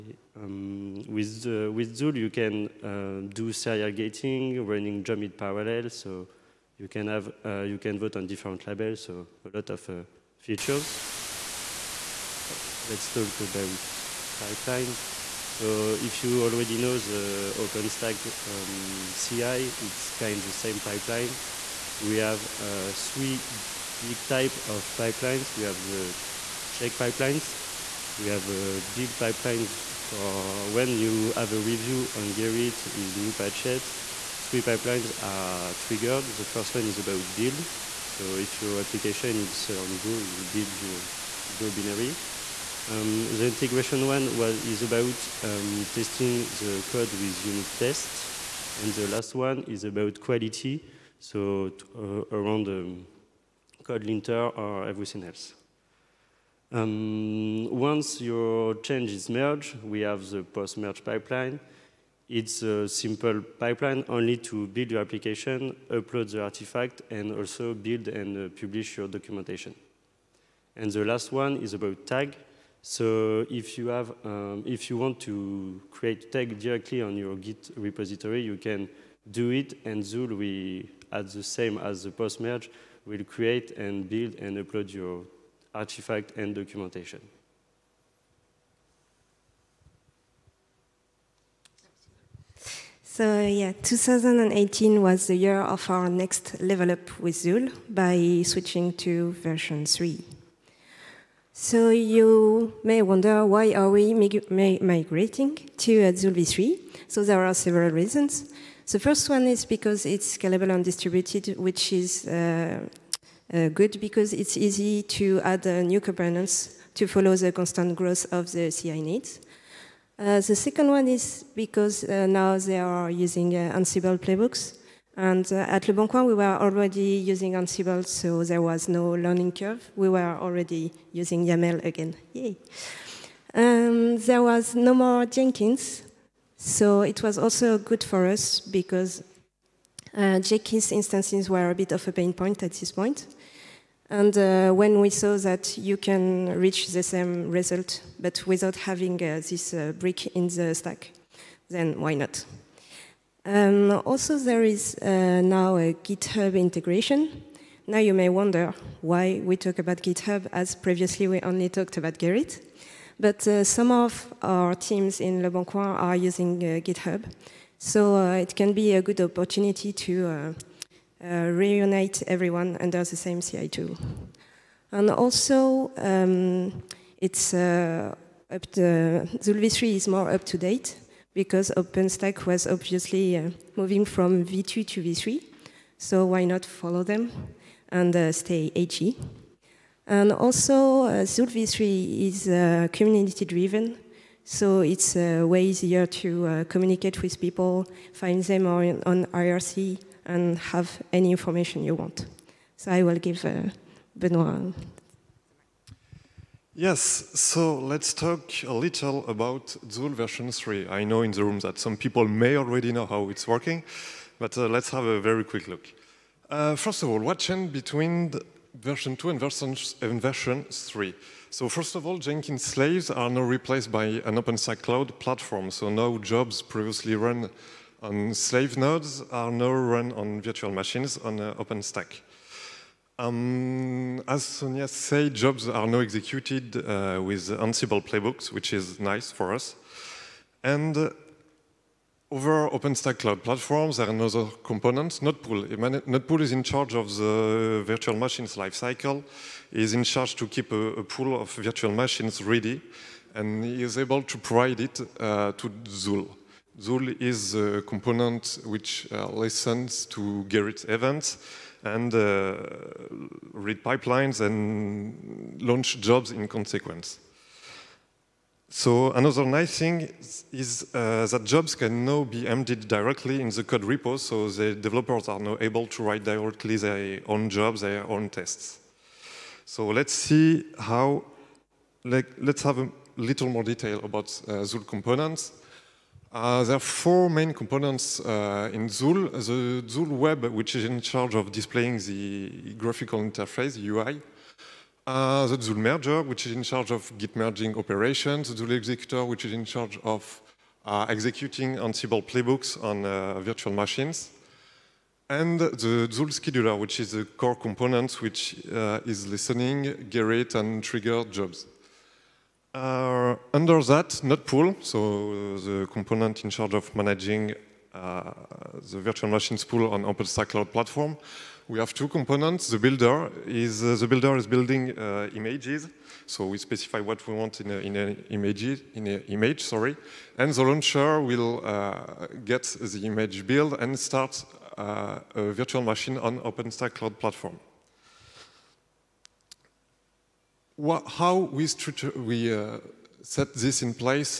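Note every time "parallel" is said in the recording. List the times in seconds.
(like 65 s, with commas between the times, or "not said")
5 s.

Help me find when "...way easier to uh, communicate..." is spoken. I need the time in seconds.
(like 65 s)
195 s.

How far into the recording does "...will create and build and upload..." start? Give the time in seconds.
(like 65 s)
83 s.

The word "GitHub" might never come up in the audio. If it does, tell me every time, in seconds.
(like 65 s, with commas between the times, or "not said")
155 s, 160 s, 166 s.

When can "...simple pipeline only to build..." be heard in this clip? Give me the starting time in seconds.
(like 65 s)
62 s.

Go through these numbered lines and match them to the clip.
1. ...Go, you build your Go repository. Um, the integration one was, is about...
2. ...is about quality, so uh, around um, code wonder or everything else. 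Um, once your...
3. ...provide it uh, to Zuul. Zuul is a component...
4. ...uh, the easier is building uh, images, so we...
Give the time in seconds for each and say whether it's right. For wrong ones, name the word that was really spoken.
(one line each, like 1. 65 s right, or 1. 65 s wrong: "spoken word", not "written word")
1. 39 s wrong: "binary", not "repository"
2. 49 s wrong: "linter", not "wonder"
3. 254 s right
4. 323 s wrong: "builder", not "easier".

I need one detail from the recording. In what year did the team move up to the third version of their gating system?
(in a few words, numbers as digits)
2018.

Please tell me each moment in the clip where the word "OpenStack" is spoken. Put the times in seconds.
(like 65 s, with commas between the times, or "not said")
17 s, 181 s, 224 s, 231 s, 242 s, 320 s, 336 s.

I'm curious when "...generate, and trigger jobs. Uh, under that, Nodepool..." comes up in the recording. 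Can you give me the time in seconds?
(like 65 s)
310 s.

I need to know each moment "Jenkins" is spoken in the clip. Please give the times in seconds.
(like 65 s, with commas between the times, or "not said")
135 s, 140 s, 222 s.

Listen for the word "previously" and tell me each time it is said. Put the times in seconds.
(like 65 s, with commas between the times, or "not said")
160 s, 226 s.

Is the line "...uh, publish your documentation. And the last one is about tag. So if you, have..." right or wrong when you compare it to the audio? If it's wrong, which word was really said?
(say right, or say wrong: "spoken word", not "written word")
right.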